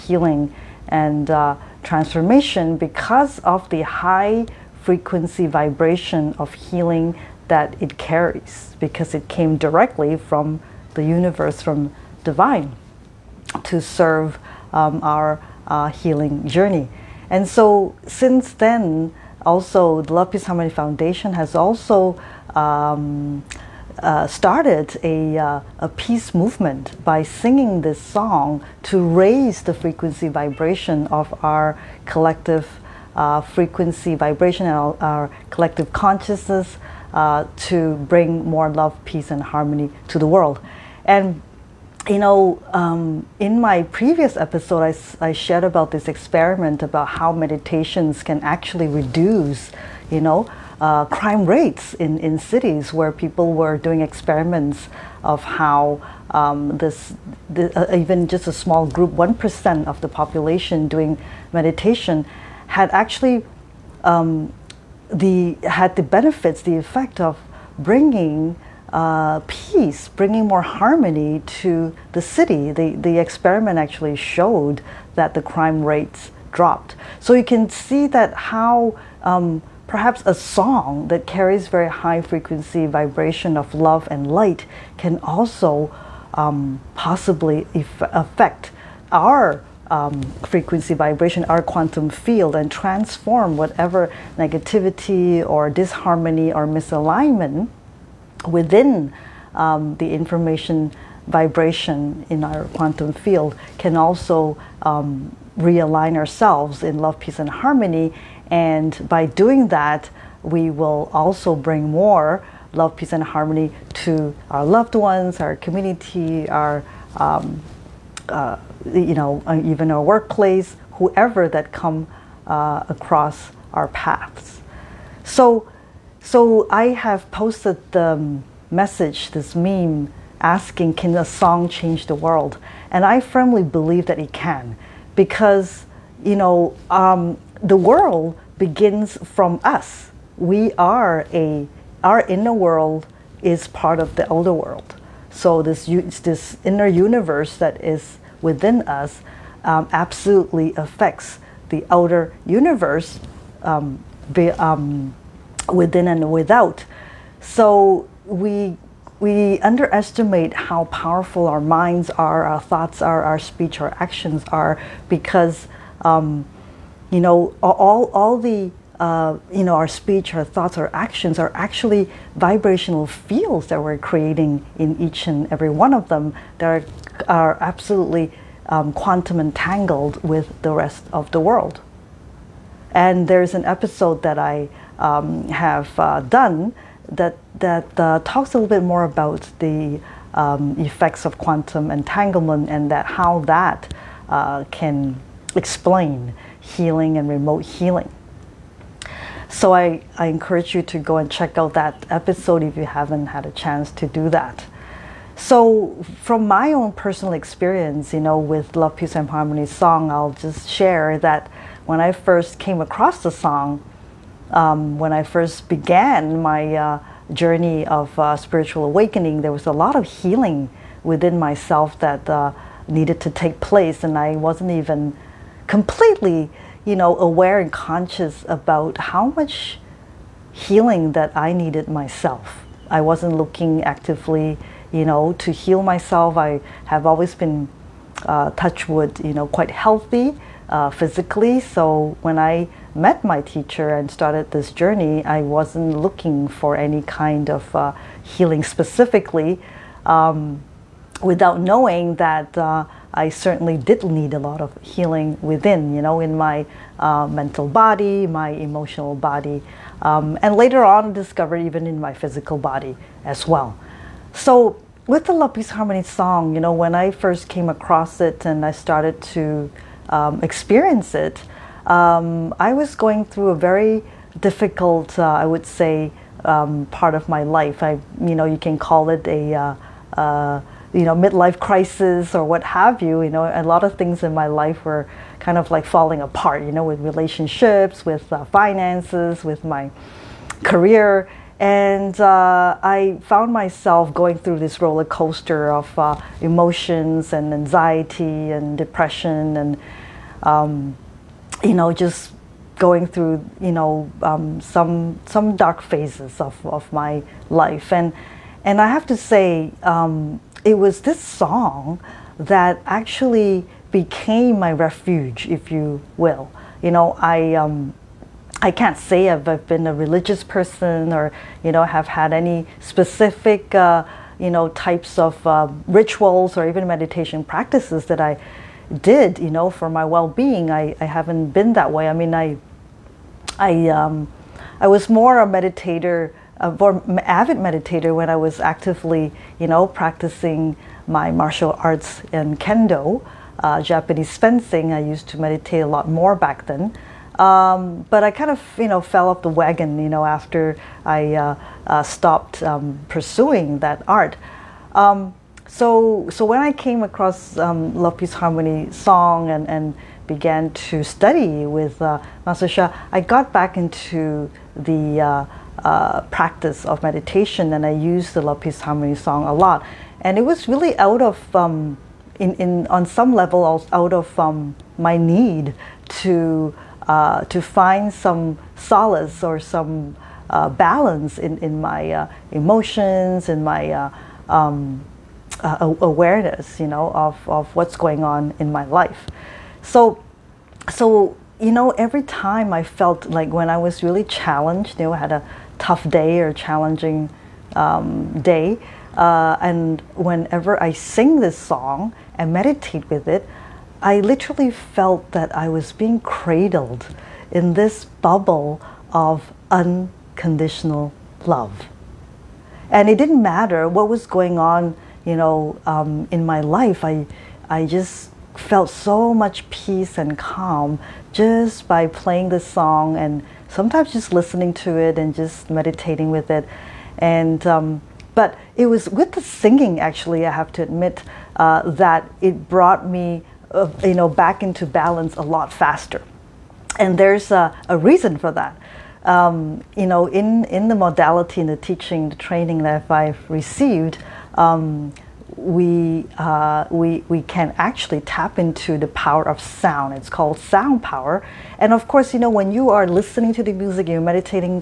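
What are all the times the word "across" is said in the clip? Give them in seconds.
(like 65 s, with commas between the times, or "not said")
122 s, 212 s, 267 s, 357 s.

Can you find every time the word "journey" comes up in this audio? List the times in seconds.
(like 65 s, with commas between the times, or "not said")
16 s, 217 s, 244 s.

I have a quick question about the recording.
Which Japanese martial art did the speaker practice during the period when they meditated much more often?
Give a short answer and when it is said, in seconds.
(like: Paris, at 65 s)
kendo, at 342 s.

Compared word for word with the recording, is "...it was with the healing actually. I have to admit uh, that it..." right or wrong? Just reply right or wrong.
wrong.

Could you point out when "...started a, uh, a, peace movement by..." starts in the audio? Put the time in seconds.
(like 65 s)
24 s.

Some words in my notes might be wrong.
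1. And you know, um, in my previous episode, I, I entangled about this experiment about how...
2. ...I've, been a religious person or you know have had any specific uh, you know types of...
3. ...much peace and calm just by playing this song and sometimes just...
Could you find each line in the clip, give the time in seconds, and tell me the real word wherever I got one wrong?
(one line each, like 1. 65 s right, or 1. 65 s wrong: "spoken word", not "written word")
1. 41 s wrong: "shared", not "entangled"
2. 319 s right
3. 419 s right.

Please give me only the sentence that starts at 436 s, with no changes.
And there's a, a reason for that.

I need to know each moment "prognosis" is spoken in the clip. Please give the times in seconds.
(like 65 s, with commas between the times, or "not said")
not said.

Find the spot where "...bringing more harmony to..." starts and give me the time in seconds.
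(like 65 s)
70 s.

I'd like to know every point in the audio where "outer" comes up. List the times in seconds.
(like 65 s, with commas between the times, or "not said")
144 s, 151 s.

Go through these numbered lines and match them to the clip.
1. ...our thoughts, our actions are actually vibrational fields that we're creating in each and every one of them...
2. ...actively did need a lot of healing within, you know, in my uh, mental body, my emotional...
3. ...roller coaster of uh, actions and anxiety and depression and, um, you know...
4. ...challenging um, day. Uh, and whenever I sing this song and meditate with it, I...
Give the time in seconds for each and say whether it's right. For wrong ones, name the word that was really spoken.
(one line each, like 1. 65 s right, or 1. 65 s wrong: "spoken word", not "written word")
1. 170 s right
2. 253 s wrong: "certainly", not "actively"
3. 294 s wrong: "emotions", not "actions"
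4. 396 s right.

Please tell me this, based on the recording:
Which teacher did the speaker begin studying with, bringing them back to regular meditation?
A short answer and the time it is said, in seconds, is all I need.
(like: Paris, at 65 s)
Master Sha, at 362 s.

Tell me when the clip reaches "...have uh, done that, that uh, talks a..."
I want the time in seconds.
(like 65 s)
185 s.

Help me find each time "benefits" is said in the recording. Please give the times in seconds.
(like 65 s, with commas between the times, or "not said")
66 s.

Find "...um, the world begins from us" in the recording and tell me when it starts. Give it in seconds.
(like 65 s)
136 s.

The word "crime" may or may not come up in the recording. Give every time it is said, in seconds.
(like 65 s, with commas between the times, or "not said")
51 s, 75 s.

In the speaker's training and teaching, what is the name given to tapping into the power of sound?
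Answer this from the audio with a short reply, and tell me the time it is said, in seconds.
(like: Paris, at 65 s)
sound power, at 450 s.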